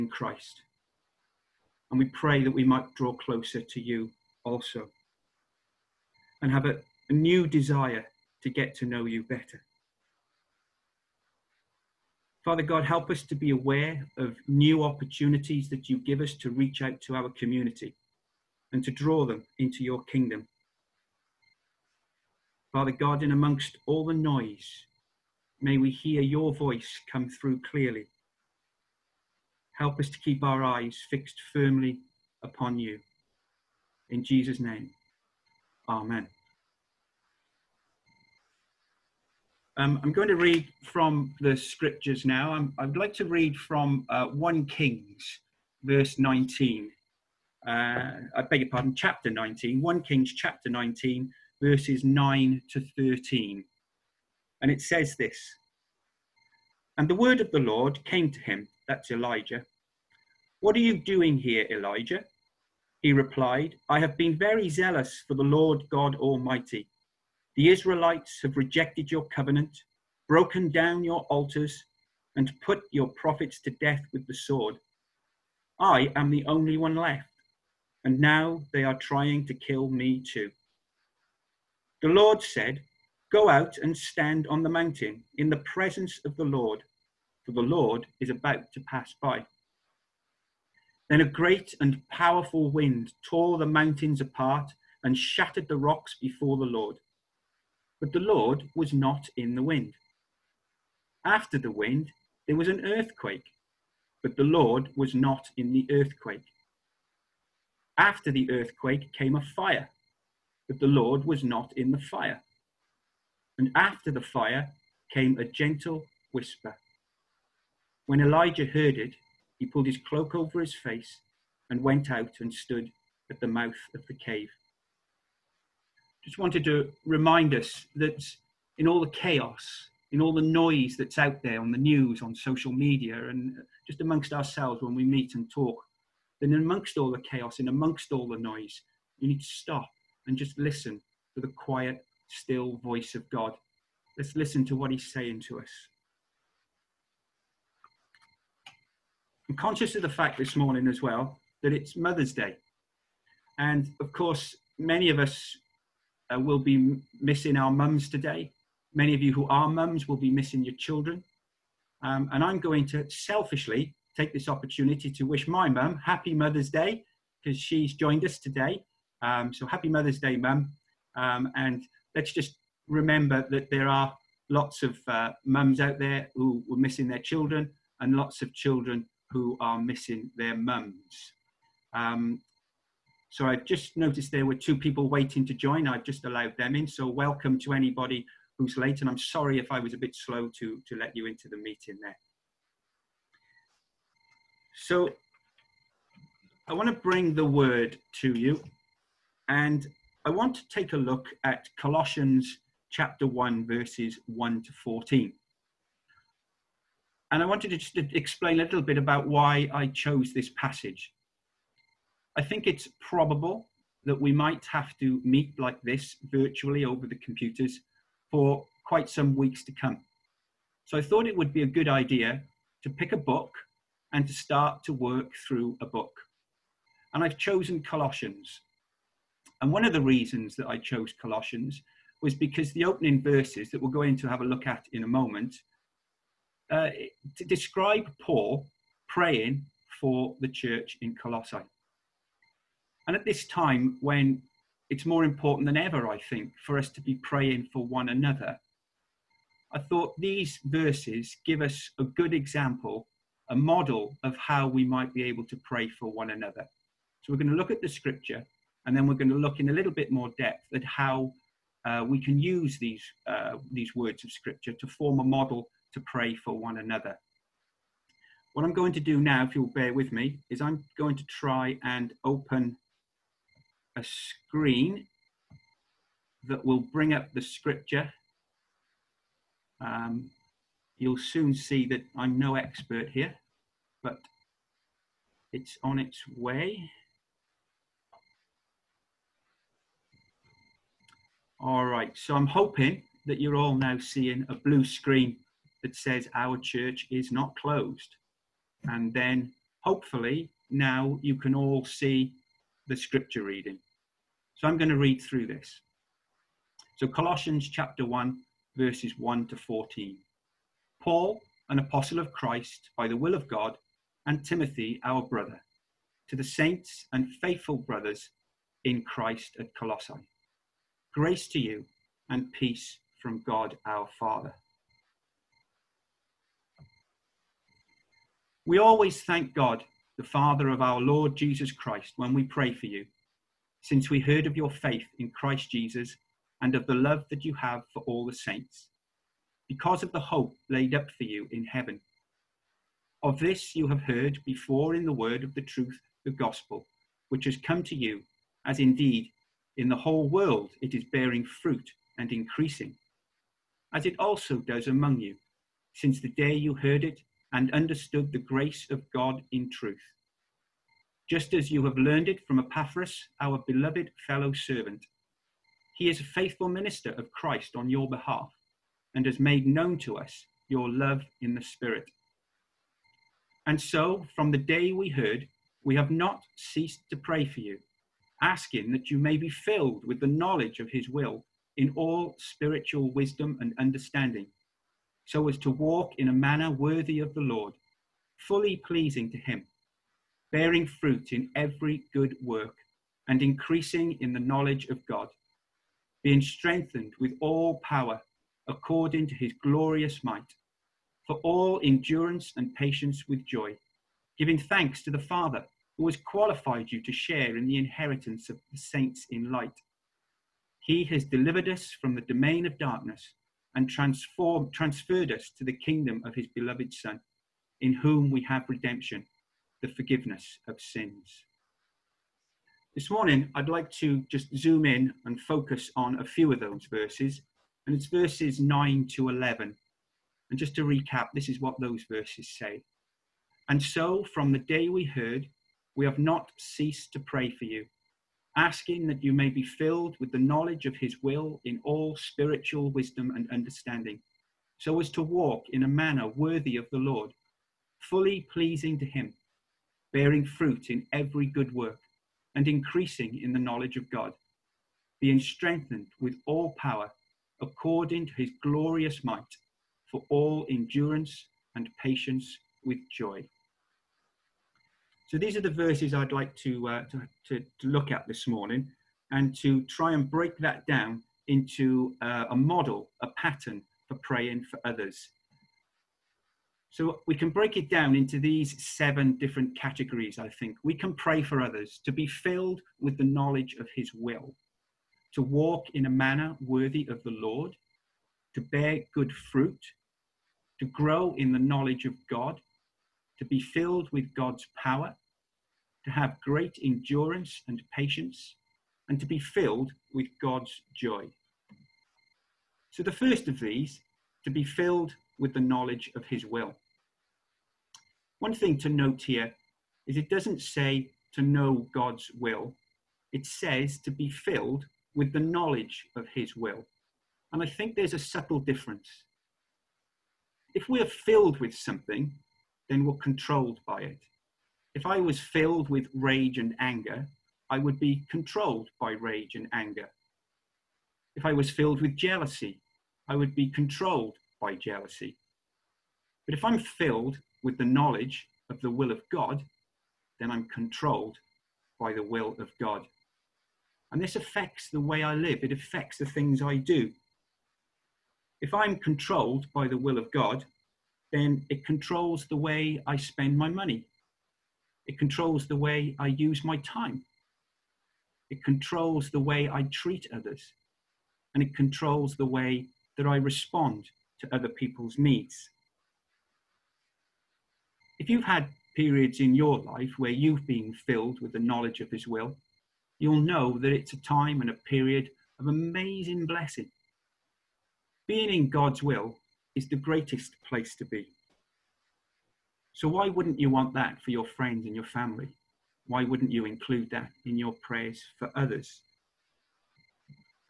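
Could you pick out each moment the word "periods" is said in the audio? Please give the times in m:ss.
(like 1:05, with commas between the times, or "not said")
9:28, 9:34.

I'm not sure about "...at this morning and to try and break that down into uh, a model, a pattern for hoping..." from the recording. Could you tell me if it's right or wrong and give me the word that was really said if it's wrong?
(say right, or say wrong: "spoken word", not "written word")
wrong: "praying", not "hoping".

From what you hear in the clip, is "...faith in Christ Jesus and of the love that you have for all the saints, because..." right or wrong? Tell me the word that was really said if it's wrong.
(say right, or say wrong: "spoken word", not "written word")
right.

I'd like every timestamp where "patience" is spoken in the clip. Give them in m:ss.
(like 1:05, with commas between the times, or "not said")
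6:42, 7:42, 8:17.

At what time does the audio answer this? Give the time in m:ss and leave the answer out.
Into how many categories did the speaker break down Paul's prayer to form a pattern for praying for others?
7:58.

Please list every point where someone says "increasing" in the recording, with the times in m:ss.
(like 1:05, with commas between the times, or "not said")
5:52, 6:33, 7:32.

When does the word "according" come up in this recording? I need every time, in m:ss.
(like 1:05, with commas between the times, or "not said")
6:38, 7:37.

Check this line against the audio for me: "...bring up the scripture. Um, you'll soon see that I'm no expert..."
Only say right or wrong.
right.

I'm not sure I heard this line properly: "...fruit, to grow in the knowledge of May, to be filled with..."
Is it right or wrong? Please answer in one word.
wrong.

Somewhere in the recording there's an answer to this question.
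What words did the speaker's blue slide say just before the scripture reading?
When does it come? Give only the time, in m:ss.
4:56.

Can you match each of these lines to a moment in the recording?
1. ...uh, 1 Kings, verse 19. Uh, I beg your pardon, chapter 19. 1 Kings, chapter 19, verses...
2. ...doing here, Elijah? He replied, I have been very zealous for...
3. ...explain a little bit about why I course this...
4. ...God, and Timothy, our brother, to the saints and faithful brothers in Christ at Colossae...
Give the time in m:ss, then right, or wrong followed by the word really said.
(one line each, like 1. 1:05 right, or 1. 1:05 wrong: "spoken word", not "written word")
1. 0:44 right
2. 1:00 right
3. 3:27 wrong: "chose", not "course"
4. 5:13 right.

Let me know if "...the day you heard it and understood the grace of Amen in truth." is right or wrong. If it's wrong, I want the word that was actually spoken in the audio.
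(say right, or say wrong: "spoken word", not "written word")
wrong: "God", not "Amen".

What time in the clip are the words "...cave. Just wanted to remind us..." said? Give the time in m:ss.
2:04.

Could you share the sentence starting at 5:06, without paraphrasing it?
So Colossians chapter 1, verses 1 to 14.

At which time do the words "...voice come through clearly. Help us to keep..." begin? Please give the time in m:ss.
0:26.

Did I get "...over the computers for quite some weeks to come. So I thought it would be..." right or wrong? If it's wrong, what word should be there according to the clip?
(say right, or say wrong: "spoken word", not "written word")
right.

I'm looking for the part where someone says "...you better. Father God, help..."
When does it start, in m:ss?
0:09.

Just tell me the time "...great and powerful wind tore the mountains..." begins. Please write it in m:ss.
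1:31.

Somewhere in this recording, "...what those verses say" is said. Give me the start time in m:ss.
7:11.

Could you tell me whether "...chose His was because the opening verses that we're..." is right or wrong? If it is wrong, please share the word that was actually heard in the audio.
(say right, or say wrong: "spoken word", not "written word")
wrong: "Colossians", not "His".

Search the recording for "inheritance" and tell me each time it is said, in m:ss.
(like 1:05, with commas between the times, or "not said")
6:47.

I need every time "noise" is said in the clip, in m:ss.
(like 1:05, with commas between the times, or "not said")
0:24, 2:10, 2:18.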